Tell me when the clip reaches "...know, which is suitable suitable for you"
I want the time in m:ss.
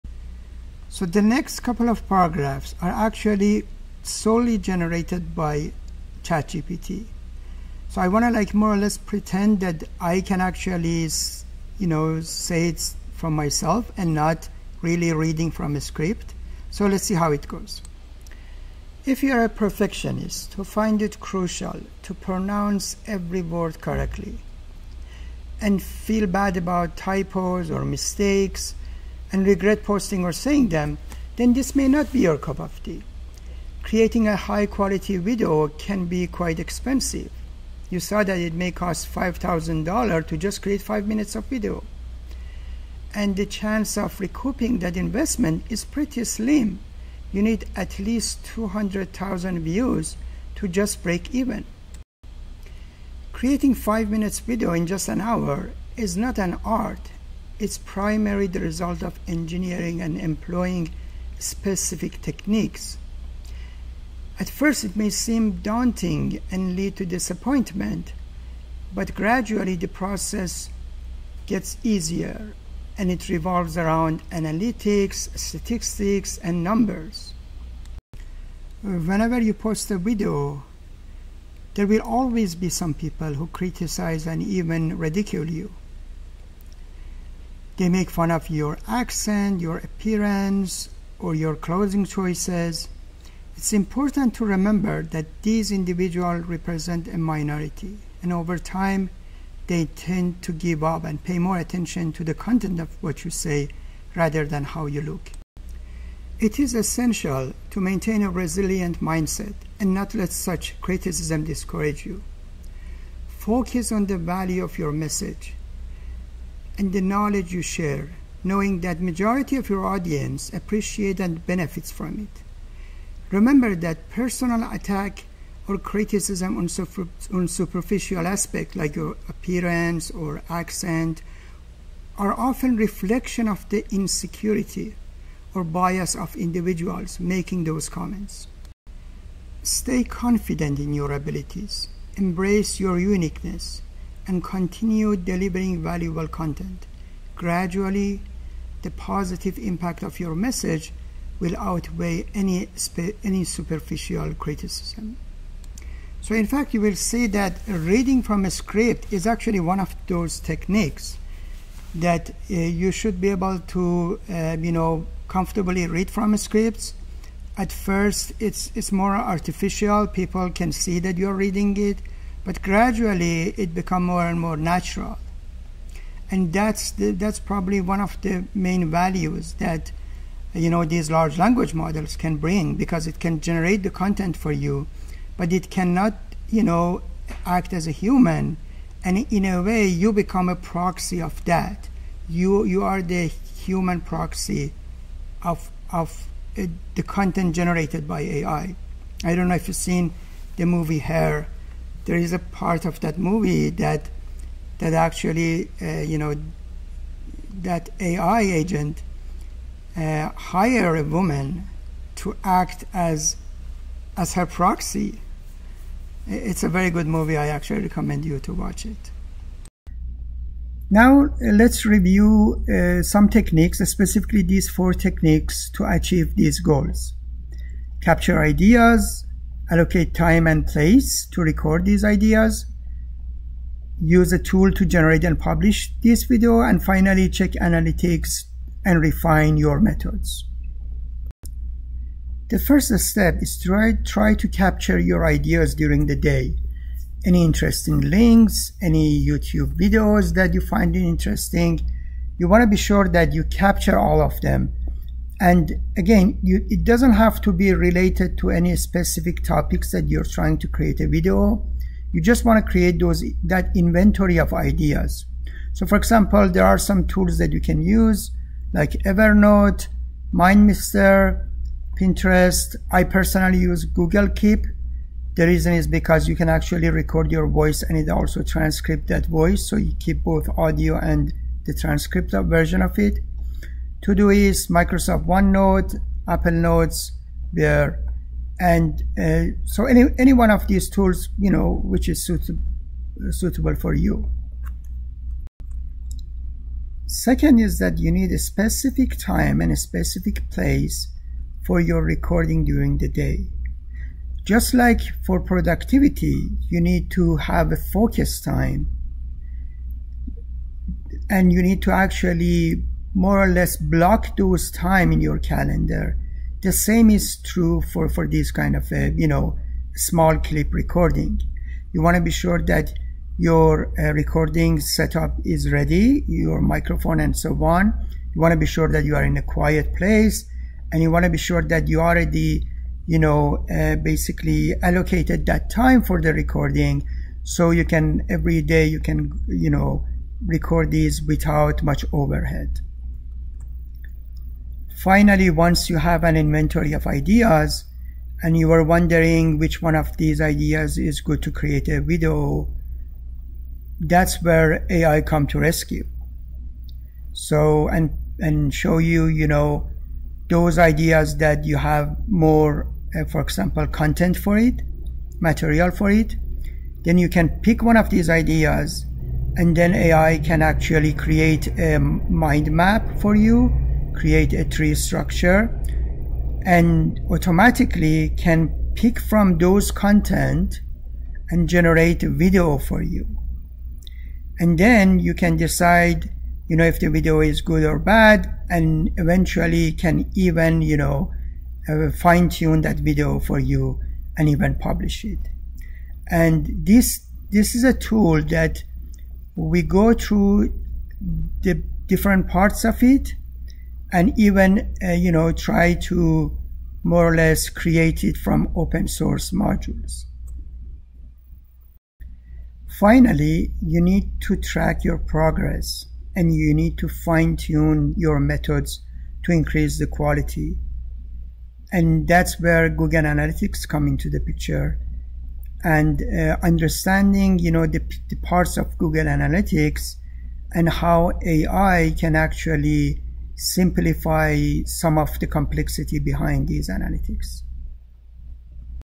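4:51.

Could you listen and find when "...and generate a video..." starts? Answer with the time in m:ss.
6:21.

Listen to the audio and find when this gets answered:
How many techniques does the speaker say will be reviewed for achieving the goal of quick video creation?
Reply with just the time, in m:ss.
3:44.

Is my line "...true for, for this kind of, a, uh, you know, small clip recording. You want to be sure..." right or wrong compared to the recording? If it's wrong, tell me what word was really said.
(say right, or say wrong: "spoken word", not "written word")
right.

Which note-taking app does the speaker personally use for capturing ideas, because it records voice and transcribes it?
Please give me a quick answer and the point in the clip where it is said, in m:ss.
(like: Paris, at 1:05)
Google Keep, at 4:33.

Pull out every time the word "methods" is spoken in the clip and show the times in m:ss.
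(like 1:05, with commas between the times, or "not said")
3:59, 6:58.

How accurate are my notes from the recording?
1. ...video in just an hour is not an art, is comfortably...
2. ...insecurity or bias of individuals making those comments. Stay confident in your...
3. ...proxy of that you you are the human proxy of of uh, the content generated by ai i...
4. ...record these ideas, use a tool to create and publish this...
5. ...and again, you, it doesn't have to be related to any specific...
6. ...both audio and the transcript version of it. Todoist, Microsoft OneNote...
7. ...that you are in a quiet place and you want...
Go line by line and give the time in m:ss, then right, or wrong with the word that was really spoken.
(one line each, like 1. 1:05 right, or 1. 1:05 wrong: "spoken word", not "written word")
1. 0:54 wrong: "primarily", not "comfortably"
2. 2:13 right
3. 3:10 right
4. 3:51 wrong: "generate", not "create"
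5. 4:15 right
6. 4:40 right
7. 5:28 right.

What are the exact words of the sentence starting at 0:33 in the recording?
Creating a high quality video can be quite expensive.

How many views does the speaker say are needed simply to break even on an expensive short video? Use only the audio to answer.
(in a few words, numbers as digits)
200,000.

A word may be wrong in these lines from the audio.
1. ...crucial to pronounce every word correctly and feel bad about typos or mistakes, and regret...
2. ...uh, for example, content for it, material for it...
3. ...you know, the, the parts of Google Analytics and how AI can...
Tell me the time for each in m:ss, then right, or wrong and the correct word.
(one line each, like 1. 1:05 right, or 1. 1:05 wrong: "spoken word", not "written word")
1. 0:21 right
2. 6:03 right
3. 7:07 right.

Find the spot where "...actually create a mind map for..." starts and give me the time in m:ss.
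6:10.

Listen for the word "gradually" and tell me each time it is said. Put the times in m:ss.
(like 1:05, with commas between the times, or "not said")
1:09, 2:27, 2:52.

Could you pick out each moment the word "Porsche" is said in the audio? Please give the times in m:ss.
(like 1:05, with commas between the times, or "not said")
not said.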